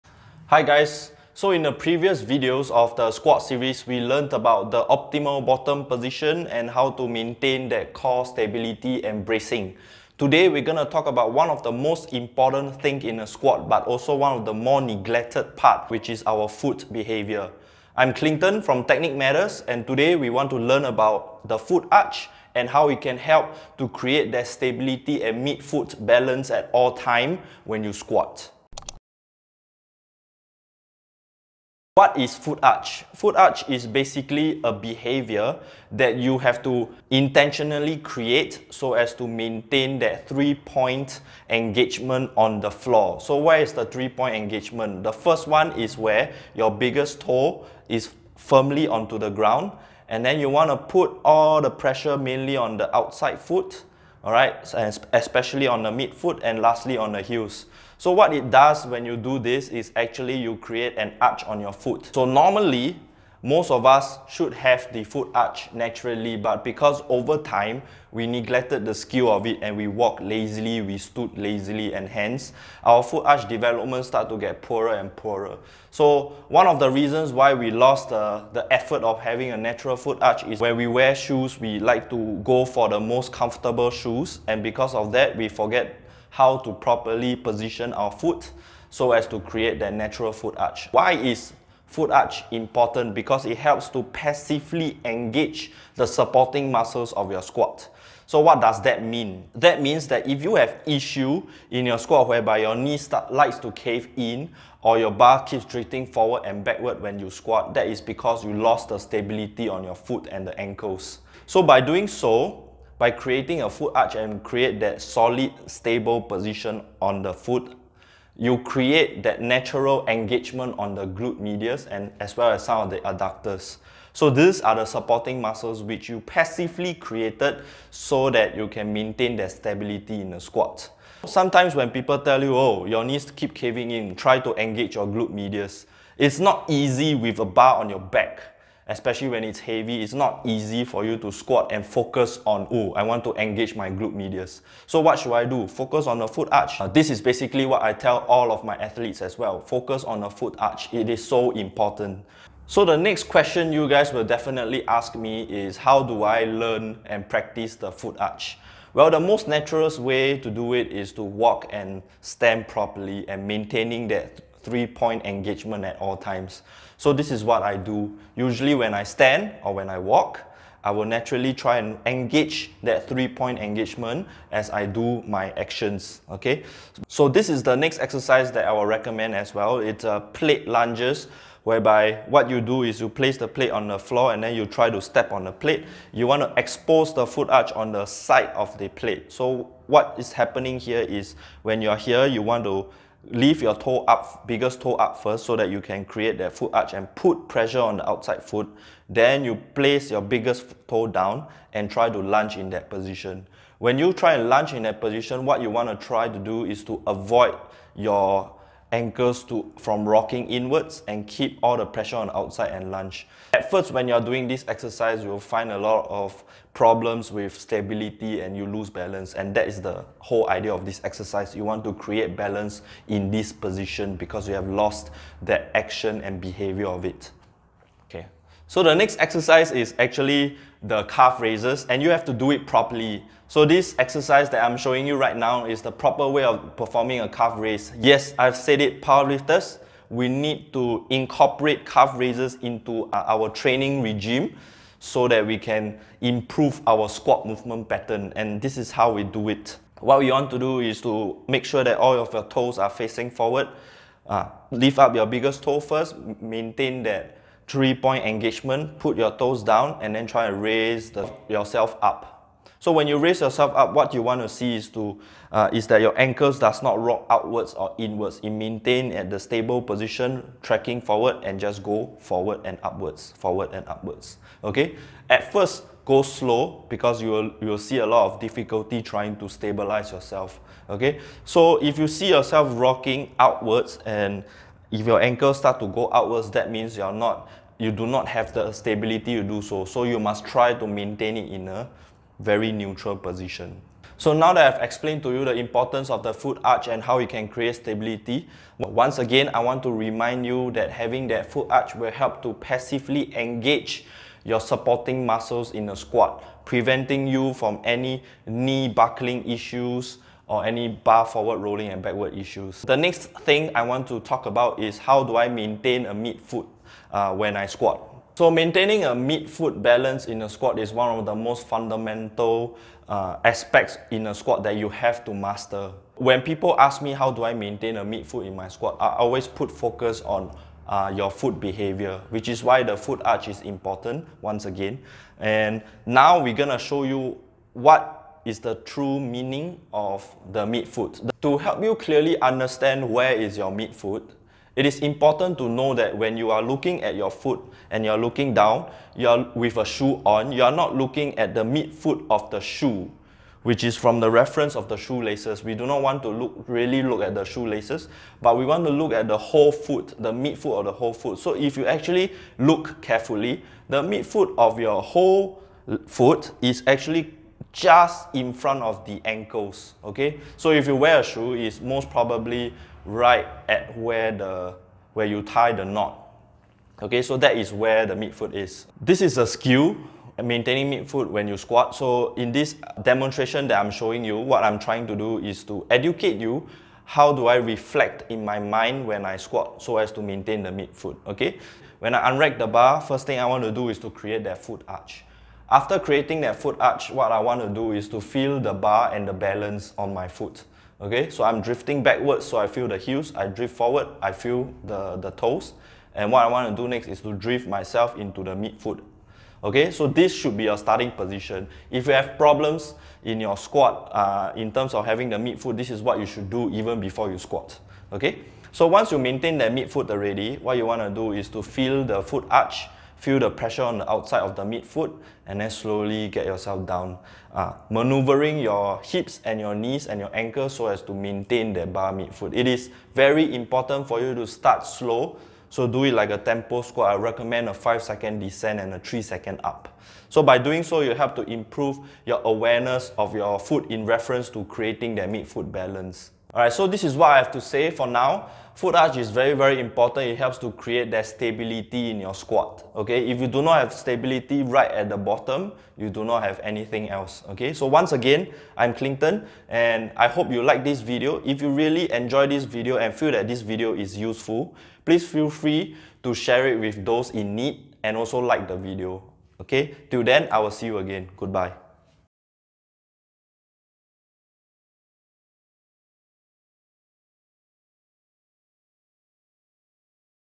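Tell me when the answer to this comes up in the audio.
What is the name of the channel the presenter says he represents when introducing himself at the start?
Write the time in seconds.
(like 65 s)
18 s.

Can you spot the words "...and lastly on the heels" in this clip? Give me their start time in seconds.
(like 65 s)
56 s.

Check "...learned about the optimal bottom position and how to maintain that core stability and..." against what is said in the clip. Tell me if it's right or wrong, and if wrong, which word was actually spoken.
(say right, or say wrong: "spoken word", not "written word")
right.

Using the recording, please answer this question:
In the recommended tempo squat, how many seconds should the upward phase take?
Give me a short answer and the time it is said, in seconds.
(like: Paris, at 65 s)
3, at 438 s.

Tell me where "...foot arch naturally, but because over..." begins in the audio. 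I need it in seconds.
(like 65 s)
65 s.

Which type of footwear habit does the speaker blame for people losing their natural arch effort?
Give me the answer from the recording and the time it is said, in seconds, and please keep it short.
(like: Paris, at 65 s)
most comfortable shoes, at 82 s.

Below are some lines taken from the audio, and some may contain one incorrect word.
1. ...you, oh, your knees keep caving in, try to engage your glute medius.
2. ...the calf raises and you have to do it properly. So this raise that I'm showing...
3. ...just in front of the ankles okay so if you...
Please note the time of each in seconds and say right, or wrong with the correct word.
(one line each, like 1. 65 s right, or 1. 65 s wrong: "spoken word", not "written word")
1. 132 s right
2. 230 s wrong: "exercise", not "raise"
3. 367 s right.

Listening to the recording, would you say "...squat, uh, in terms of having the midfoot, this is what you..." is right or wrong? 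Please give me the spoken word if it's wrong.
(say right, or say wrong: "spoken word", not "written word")
right.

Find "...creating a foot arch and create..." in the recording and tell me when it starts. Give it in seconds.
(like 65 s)
113 s.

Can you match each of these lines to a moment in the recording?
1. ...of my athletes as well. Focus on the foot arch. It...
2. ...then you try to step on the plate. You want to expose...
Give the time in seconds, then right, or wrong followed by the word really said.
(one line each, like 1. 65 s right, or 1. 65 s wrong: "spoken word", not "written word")
1. 148 s right
2. 184 s right.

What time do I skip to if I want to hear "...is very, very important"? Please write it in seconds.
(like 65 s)
449 s.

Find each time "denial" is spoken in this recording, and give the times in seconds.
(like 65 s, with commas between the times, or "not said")
not said.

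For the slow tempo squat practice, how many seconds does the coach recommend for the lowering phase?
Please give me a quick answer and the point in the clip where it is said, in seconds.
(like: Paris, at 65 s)
5, at 437 s.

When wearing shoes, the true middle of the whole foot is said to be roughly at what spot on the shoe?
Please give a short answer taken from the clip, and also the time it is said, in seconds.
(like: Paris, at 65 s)
where you tie the knot, at 375 s.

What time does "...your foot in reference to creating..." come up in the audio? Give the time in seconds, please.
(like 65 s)
443 s.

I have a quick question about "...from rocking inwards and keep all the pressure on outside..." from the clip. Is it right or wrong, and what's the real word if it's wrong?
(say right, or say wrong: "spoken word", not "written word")
right.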